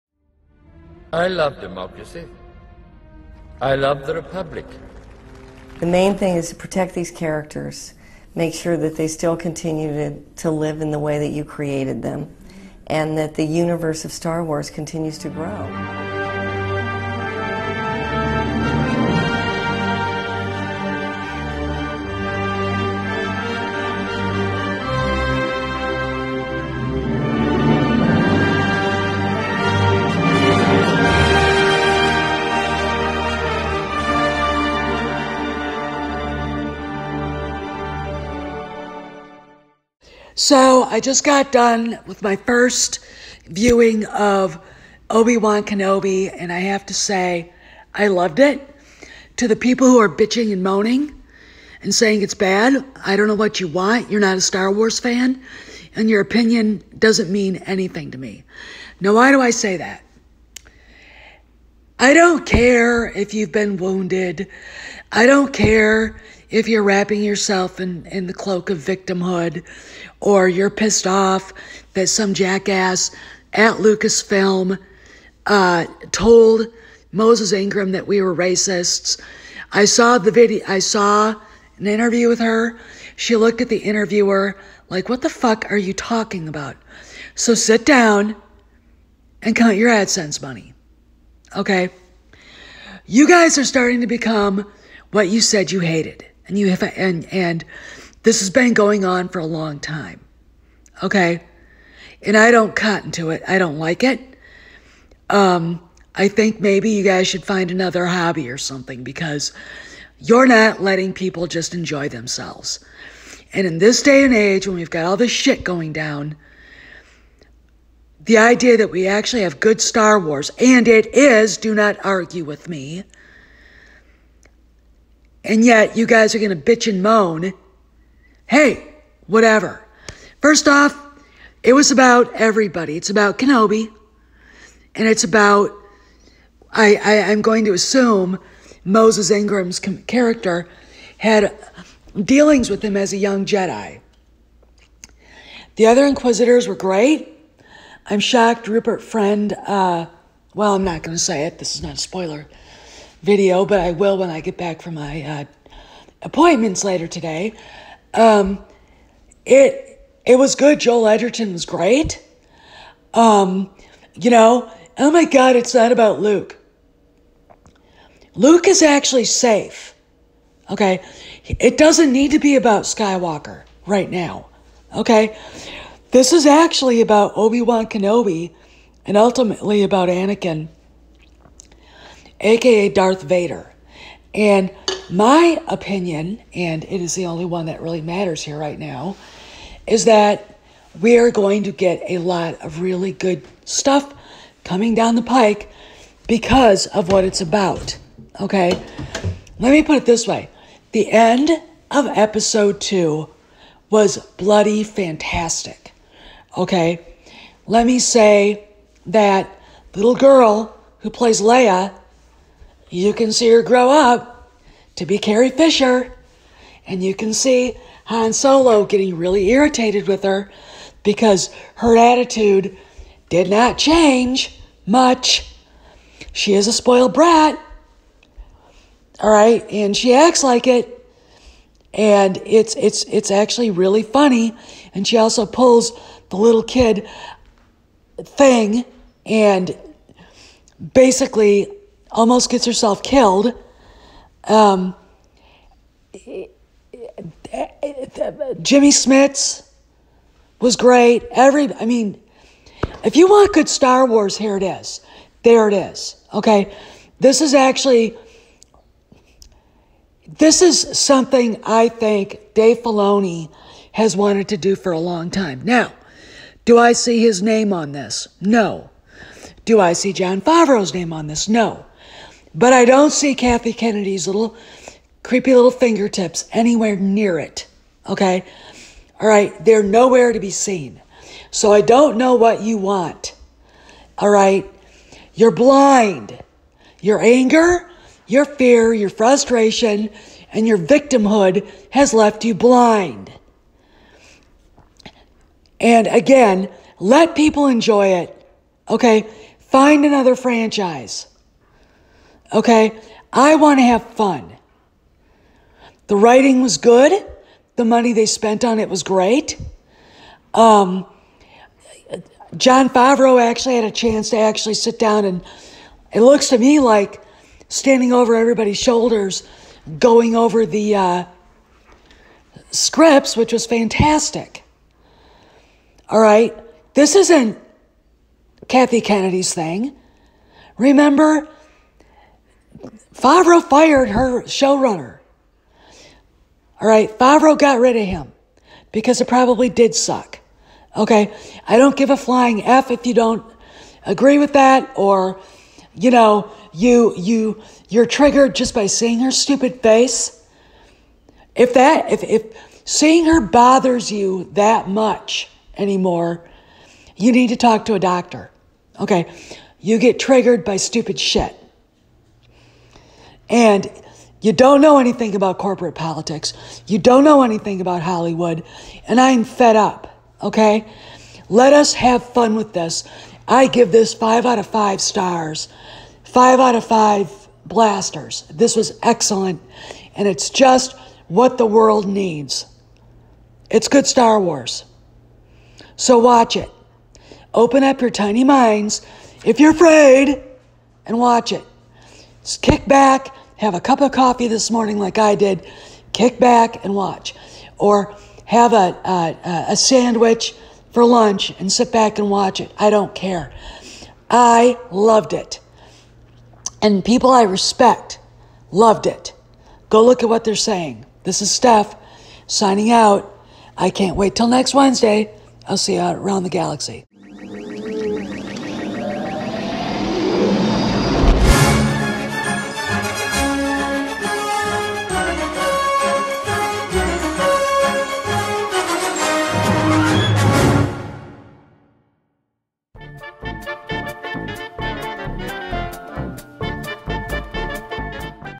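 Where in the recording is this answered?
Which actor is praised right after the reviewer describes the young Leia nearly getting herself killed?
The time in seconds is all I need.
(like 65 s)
248 s.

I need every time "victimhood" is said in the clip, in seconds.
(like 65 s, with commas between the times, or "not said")
68 s, 290 s.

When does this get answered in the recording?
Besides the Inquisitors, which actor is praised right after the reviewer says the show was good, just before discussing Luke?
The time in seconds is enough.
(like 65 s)
160 s.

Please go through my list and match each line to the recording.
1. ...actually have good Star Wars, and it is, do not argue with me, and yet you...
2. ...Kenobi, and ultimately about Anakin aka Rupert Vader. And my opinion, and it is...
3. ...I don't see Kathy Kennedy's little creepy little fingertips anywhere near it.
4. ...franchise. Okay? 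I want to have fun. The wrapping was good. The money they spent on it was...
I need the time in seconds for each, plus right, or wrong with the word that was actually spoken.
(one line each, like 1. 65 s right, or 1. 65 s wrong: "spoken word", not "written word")
1. 119 s right
2. 177 s wrong: "Darth", not "Rupert"
3. 272 s right
4. 300 s wrong: "writing", not "wrapping".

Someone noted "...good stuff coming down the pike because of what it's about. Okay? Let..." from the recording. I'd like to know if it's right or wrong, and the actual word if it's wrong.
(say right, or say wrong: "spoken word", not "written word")
right.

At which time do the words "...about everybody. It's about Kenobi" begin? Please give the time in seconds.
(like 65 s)
131 s.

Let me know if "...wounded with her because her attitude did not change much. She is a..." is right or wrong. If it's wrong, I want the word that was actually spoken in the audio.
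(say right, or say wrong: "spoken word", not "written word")
wrong: "irritated", not "wounded".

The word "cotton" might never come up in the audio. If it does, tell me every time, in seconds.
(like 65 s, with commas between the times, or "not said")
102 s.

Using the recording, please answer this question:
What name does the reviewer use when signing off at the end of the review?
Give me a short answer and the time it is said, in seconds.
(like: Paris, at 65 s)
Steph, at 411 s.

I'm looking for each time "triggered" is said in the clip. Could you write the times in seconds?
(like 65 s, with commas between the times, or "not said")
348 s, 360 s.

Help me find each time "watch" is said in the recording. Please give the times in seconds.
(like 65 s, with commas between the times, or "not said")
386 s, 391 s, 396 s, 402 s.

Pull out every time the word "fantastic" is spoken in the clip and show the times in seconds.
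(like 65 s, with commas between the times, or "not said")
204 s, 323 s.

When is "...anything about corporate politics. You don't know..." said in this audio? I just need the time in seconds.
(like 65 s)
364 s.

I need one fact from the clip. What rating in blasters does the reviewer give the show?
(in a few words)
5 out of 5.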